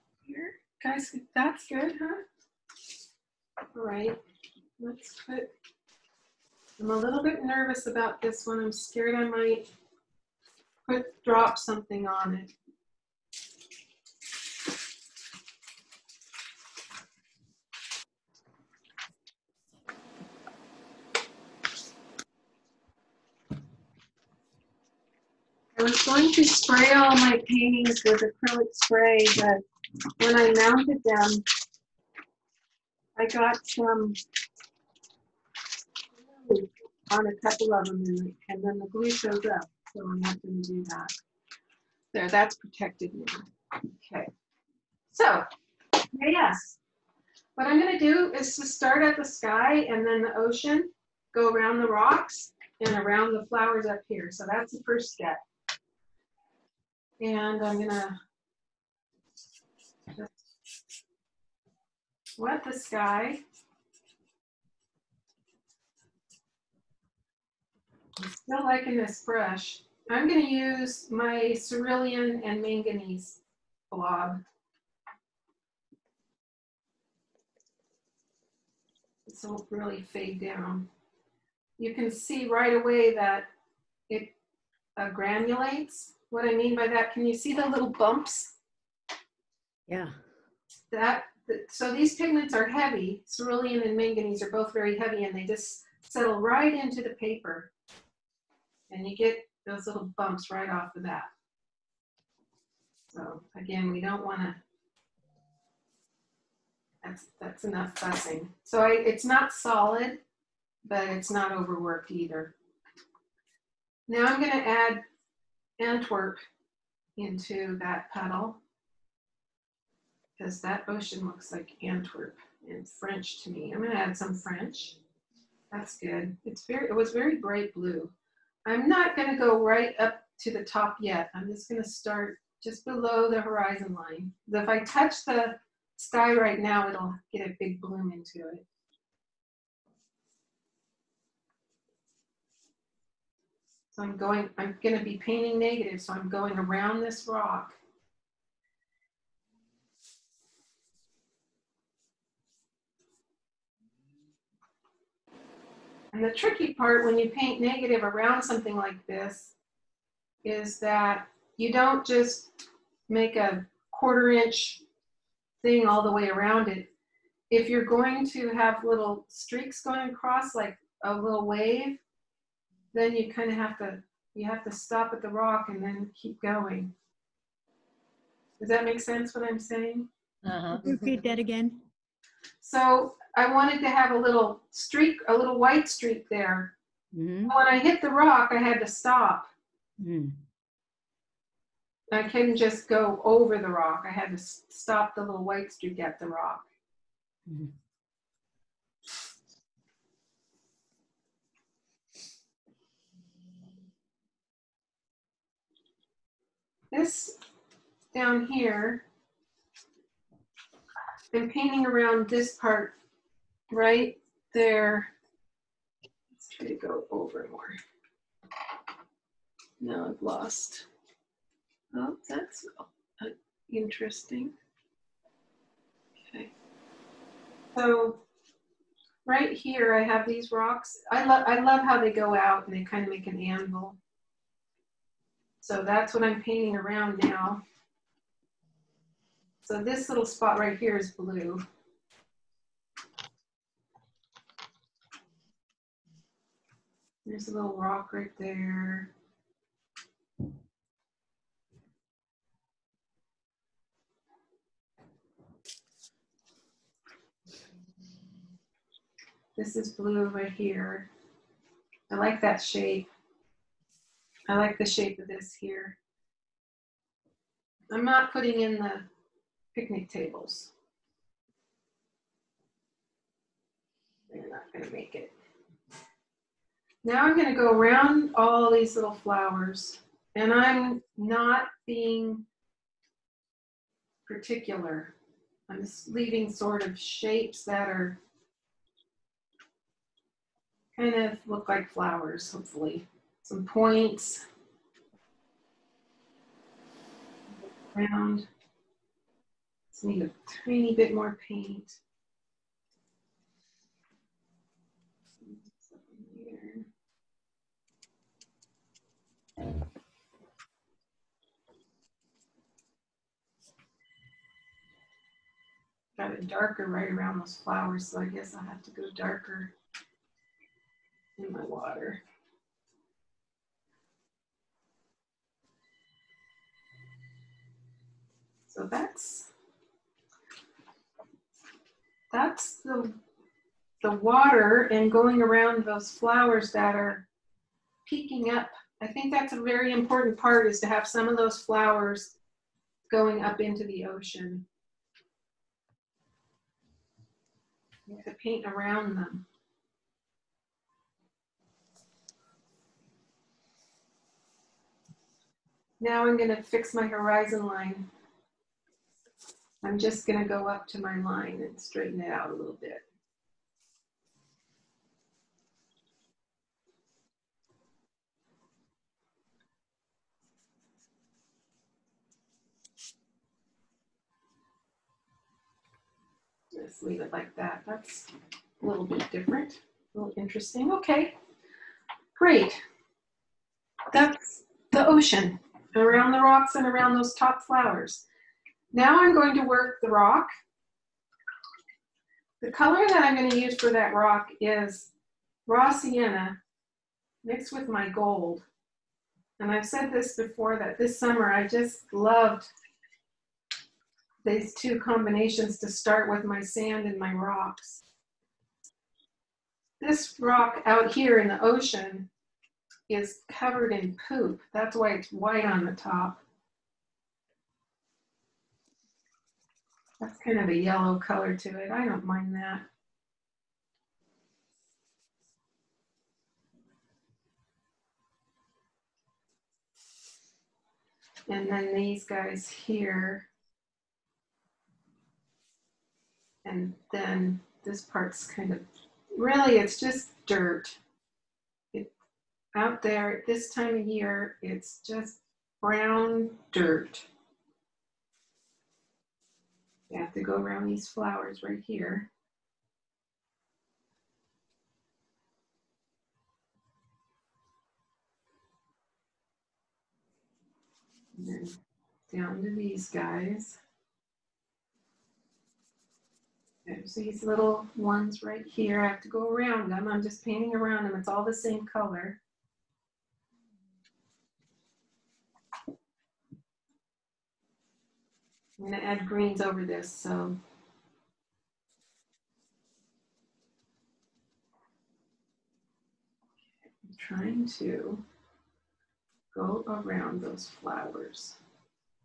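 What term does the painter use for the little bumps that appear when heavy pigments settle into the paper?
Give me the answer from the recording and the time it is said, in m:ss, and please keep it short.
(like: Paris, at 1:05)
Granulates, at 1:25.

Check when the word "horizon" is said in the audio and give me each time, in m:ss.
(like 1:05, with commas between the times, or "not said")
2:13, 5:57.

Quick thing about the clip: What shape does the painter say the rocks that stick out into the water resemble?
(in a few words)
An anvil.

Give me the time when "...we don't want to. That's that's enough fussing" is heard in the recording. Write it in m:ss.
1:43.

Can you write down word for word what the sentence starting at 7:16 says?
And then this part's kind of, really it's just dirt.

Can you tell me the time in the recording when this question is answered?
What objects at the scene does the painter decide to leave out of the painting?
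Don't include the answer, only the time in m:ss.
4:29.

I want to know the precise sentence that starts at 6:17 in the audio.
That's a little bit different, a little interesting.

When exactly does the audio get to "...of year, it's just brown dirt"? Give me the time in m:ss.
7:23.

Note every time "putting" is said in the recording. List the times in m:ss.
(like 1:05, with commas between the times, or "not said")
4:28.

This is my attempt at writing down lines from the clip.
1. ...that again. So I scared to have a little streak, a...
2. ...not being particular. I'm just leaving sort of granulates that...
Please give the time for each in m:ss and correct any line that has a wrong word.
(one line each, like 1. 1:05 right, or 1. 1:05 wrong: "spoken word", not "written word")
1. 3:01 wrong: "wanted", not "scared"
2. 4:41 wrong: "shapes", not "granulates".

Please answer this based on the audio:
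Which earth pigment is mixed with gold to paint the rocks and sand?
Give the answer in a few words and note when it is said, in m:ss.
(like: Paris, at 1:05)
Raw sienna, at 6:35.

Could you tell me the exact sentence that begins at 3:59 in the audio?
So this little spot right here is blue.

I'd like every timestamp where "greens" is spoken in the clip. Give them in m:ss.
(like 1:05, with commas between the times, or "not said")
7:59.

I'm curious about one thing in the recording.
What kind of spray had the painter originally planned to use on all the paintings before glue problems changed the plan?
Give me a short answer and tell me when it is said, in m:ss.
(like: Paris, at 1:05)
Acrylic spray, at 0:28.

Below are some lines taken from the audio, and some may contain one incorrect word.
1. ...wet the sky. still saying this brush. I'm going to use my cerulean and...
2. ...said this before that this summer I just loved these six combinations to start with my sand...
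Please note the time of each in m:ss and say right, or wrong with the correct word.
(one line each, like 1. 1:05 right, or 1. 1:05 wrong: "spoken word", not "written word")
1. 1:02 wrong: "liking", not "saying"
2. 6:39 wrong: "two", not "six".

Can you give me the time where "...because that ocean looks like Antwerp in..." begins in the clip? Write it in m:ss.
2:00.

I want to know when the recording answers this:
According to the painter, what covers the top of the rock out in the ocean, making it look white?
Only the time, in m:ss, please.
6:54.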